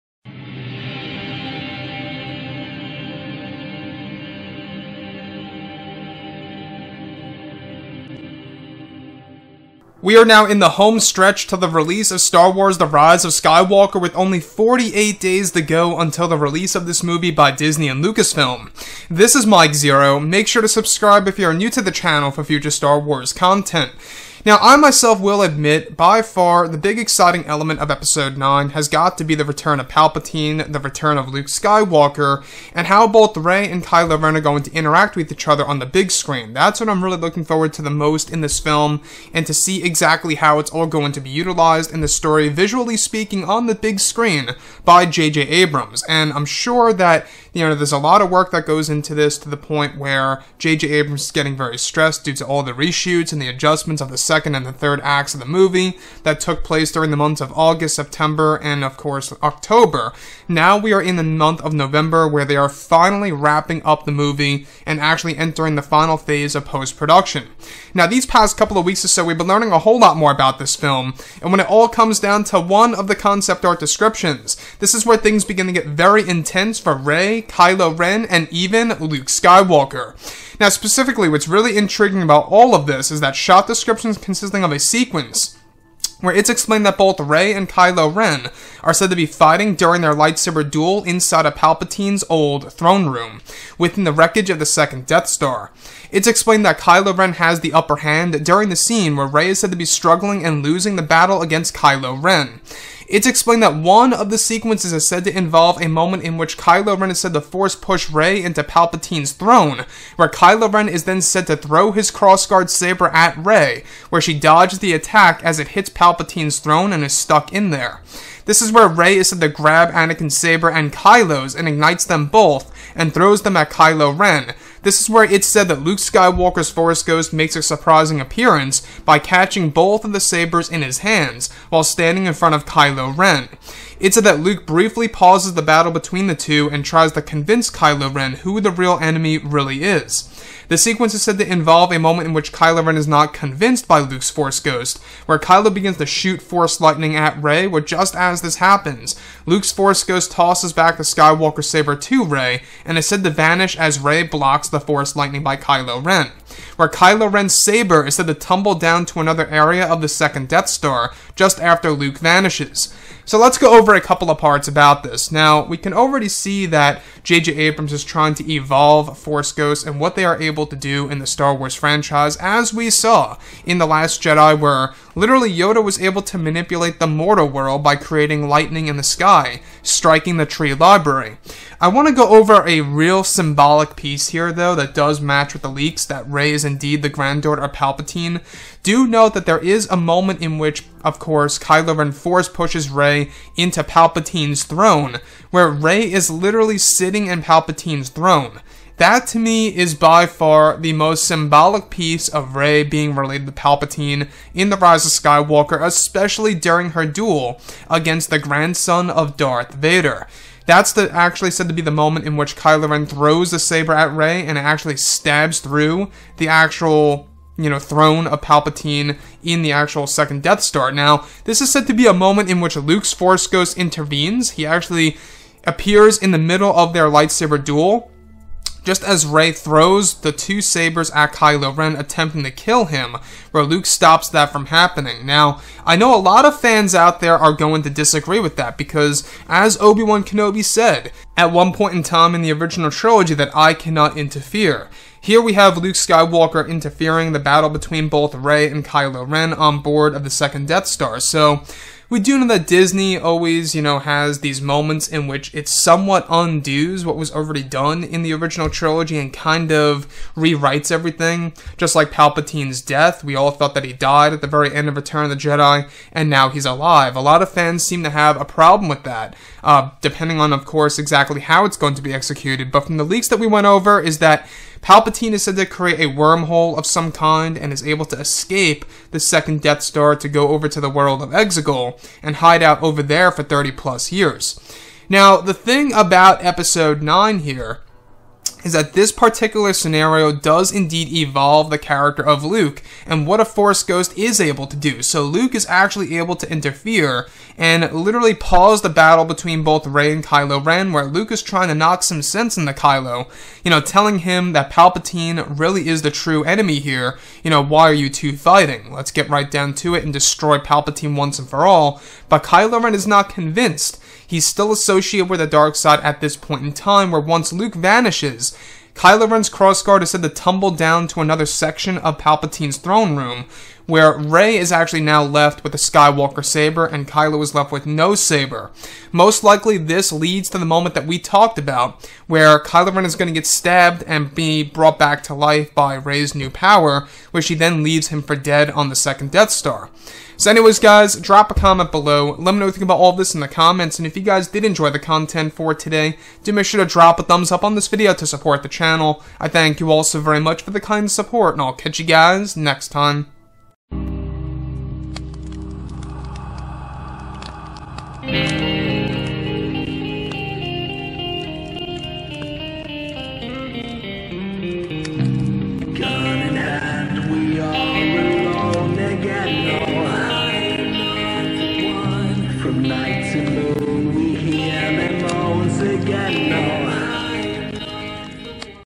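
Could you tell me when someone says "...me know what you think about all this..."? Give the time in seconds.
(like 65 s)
342 s.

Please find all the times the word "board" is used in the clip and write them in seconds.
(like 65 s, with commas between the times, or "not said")
249 s.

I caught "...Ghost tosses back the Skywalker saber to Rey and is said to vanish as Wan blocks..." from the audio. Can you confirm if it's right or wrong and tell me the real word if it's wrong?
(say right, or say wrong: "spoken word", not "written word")
wrong: "Rey", not "Wan".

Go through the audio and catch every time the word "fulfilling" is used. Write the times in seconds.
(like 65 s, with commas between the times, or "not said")
not said.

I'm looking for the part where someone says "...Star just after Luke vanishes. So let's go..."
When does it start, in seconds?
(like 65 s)
160 s.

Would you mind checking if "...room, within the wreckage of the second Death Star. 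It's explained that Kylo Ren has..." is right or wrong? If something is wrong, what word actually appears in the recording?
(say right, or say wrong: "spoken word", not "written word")
right.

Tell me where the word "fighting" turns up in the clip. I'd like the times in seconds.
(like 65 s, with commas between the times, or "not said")
89 s, 308 s.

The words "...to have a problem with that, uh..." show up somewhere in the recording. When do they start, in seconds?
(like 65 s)
268 s.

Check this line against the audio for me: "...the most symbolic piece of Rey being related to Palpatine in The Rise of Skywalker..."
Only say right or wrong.
right.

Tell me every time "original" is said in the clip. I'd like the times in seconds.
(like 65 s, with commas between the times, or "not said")
242 s, 258 s.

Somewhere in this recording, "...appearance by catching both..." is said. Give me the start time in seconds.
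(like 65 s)
128 s.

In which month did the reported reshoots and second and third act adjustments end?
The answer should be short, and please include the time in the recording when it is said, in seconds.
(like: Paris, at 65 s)
October, at 59 s.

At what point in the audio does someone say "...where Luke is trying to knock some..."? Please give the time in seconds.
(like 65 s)
300 s.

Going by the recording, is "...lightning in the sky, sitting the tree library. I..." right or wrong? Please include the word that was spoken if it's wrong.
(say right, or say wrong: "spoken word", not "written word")
wrong: "striking", not "sitting".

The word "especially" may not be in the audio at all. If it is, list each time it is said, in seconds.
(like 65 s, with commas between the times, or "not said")
205 s.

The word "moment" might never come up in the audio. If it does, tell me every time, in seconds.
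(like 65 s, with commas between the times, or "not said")
105 s, 141 s, 189 s, 211 s, 222 s, 254 s, 330 s.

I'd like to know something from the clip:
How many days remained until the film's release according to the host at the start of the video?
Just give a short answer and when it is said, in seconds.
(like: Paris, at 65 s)
48, at 14 s.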